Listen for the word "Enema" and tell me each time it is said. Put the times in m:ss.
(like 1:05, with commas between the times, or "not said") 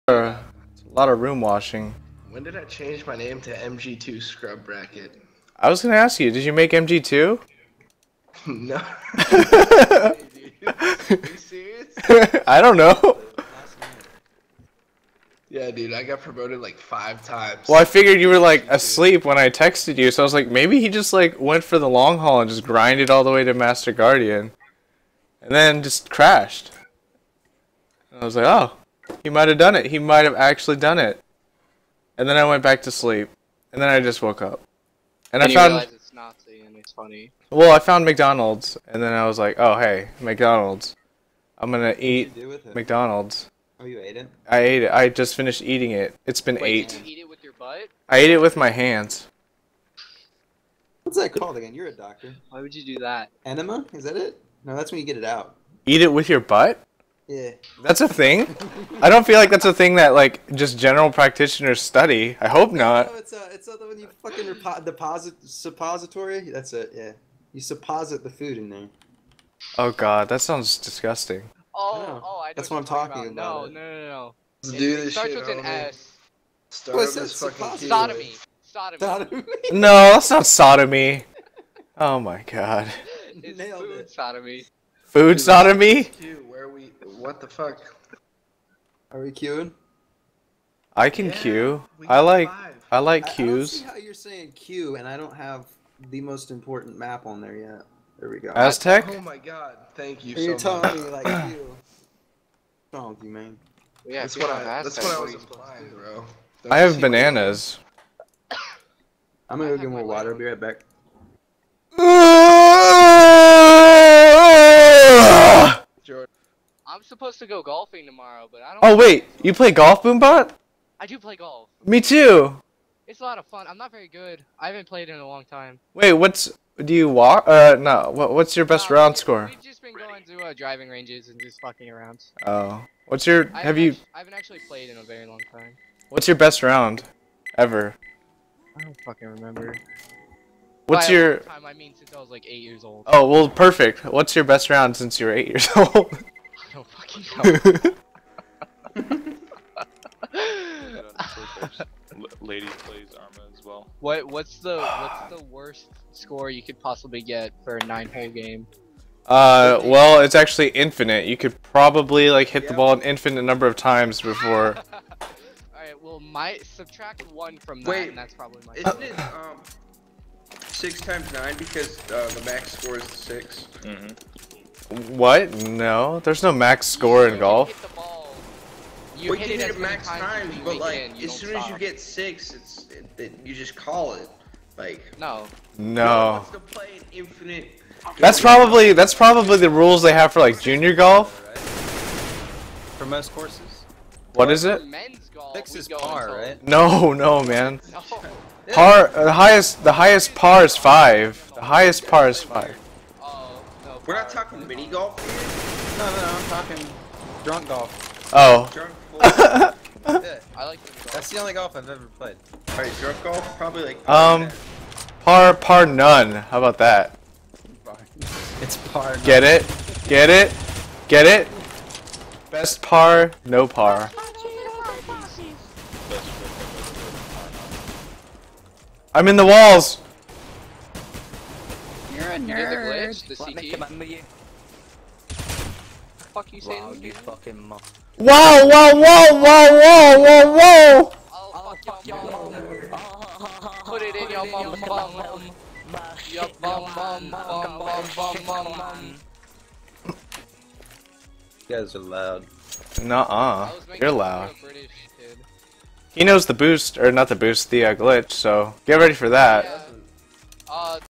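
0:53.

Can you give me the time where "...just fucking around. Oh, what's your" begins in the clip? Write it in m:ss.
2:11.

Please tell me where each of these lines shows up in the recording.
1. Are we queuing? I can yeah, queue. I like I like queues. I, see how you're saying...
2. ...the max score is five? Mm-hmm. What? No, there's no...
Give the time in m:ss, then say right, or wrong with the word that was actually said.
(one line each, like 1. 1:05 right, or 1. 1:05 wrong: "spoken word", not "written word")
1. 1:29 right
2. 2:52 wrong: "six", not "five".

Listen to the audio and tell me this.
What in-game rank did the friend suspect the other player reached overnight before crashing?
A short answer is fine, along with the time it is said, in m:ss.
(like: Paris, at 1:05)
Master Guardian, at 0:23.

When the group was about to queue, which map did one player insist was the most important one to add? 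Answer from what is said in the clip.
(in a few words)
Aztec.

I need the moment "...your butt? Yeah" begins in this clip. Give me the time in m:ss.
0:56.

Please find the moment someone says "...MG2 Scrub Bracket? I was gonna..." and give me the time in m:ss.
0:03.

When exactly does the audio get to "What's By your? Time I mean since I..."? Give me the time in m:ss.
2:20.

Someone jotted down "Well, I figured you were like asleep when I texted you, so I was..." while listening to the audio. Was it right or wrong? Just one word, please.
right.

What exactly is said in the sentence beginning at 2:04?
I haven't played in a long time.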